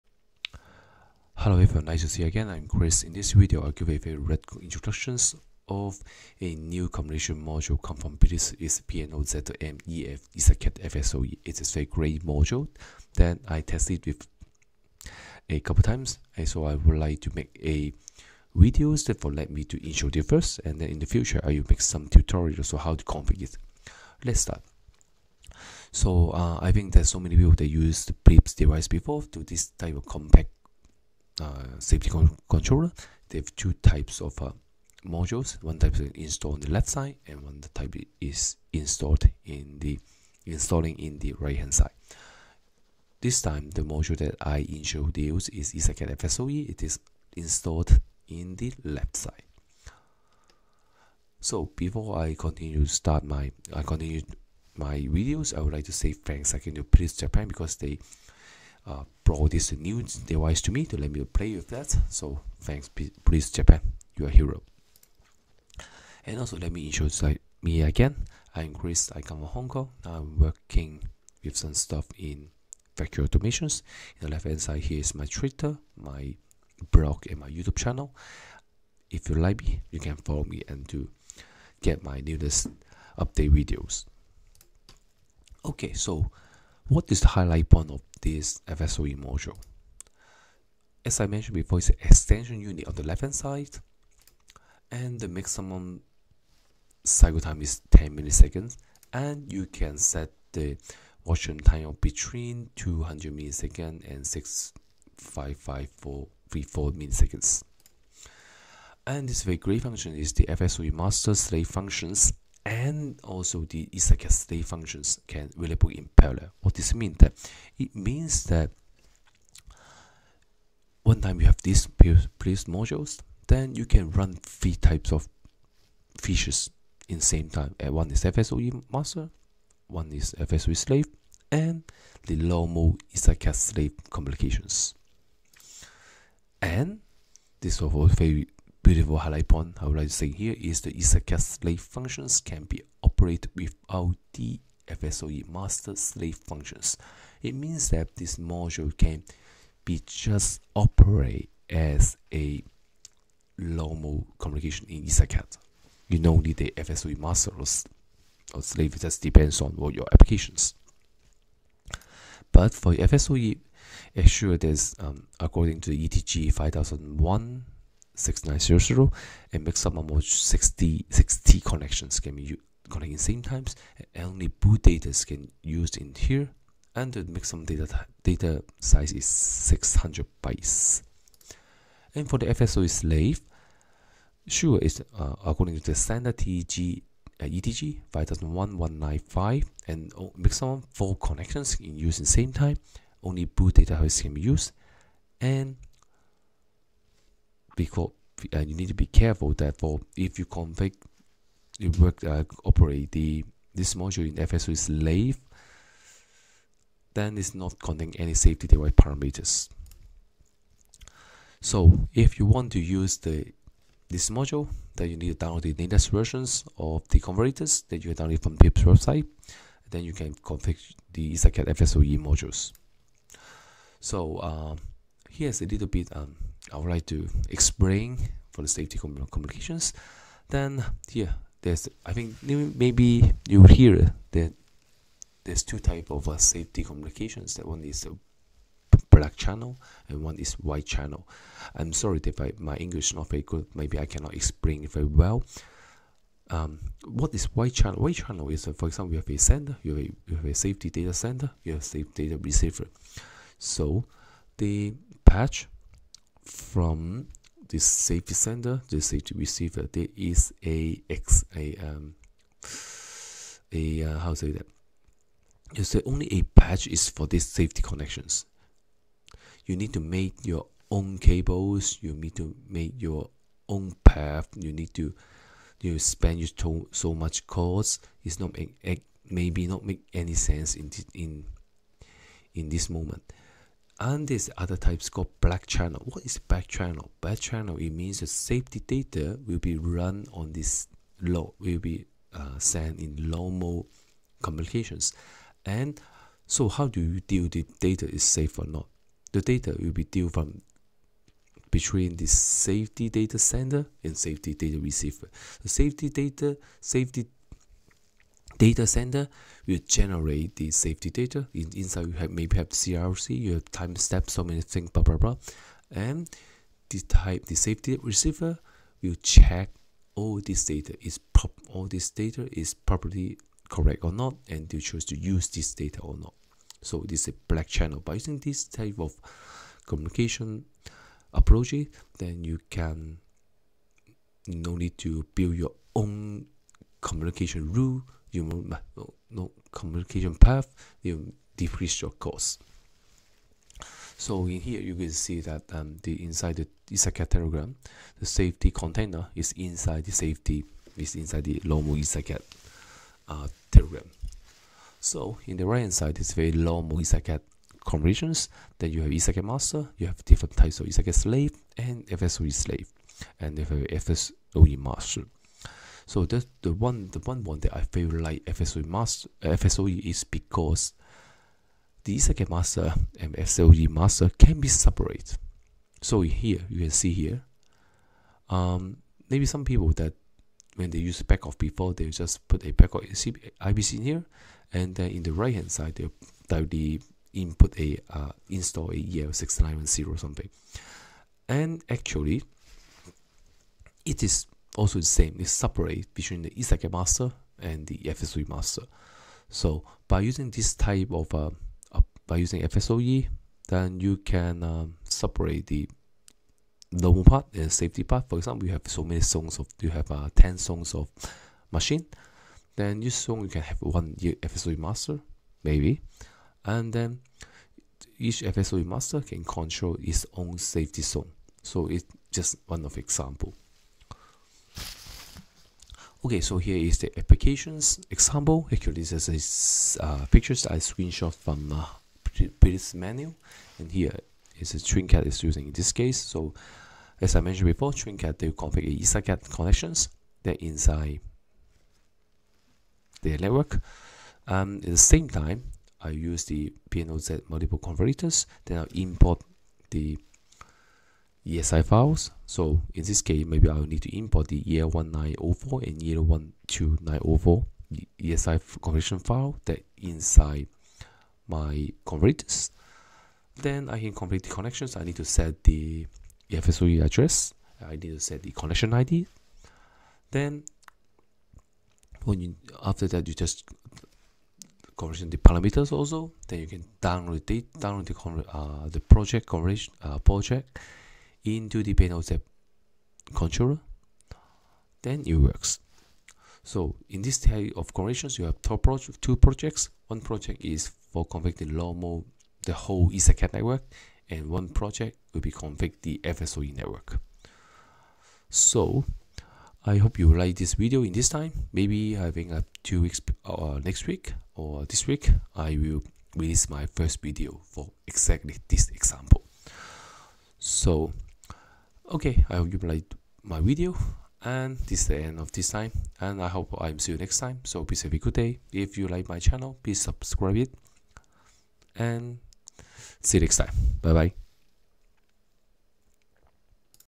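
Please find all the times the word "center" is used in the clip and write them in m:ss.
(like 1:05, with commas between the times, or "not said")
4:18, 5:08.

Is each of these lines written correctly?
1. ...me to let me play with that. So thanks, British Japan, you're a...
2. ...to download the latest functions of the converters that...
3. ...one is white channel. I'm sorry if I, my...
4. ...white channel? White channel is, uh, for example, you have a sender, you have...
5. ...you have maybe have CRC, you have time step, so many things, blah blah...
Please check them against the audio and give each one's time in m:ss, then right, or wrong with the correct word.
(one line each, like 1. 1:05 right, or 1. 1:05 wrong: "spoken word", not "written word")
1. 1:00 wrong: "Pilz", not "British"
2. 3:35 wrong: "versions", not "functions"
3. 4:00 right
4. 4:07 right
5. 5:12 right.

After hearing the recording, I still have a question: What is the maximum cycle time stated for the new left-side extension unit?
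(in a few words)
10 milliseconds.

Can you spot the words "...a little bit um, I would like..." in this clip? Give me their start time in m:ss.
3:45.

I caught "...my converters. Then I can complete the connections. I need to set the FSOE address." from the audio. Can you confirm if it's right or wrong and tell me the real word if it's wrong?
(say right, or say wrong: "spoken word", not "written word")
right.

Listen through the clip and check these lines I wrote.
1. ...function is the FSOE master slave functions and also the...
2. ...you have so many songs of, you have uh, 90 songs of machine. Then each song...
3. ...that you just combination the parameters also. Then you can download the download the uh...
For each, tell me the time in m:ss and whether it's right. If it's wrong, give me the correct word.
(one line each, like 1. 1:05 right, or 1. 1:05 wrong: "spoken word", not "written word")
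1. 1:49 right
2. 6:48 wrong: "10", not "90"
3. 7:53 wrong: "conversion", not "combination".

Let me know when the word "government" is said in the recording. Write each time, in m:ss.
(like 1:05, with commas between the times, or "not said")
not said.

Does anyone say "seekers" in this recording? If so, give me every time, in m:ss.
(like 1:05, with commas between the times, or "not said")
not said.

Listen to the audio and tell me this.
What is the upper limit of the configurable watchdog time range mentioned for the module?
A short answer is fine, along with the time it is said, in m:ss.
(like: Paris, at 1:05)
6554 milliseconds, at 1:44.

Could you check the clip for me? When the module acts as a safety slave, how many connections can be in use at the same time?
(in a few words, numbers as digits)
4.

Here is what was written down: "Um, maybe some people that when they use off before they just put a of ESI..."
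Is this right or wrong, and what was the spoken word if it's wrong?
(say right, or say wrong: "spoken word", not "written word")
wrong: "IPC", not "ESI".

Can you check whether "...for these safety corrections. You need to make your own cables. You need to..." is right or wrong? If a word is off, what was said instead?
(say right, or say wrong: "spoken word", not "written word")
wrong: "connections", not "corrections".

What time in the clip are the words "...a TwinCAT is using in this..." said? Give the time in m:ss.
7:14.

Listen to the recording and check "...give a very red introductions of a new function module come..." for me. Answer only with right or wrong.
wrong.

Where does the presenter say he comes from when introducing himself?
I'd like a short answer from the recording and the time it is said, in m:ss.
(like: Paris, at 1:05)
Hong Kong, at 1:09.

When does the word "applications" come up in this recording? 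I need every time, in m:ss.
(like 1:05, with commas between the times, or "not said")
2:40, 7:07.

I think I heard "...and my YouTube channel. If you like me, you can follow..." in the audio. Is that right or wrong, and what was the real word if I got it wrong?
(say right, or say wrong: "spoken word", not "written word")
right.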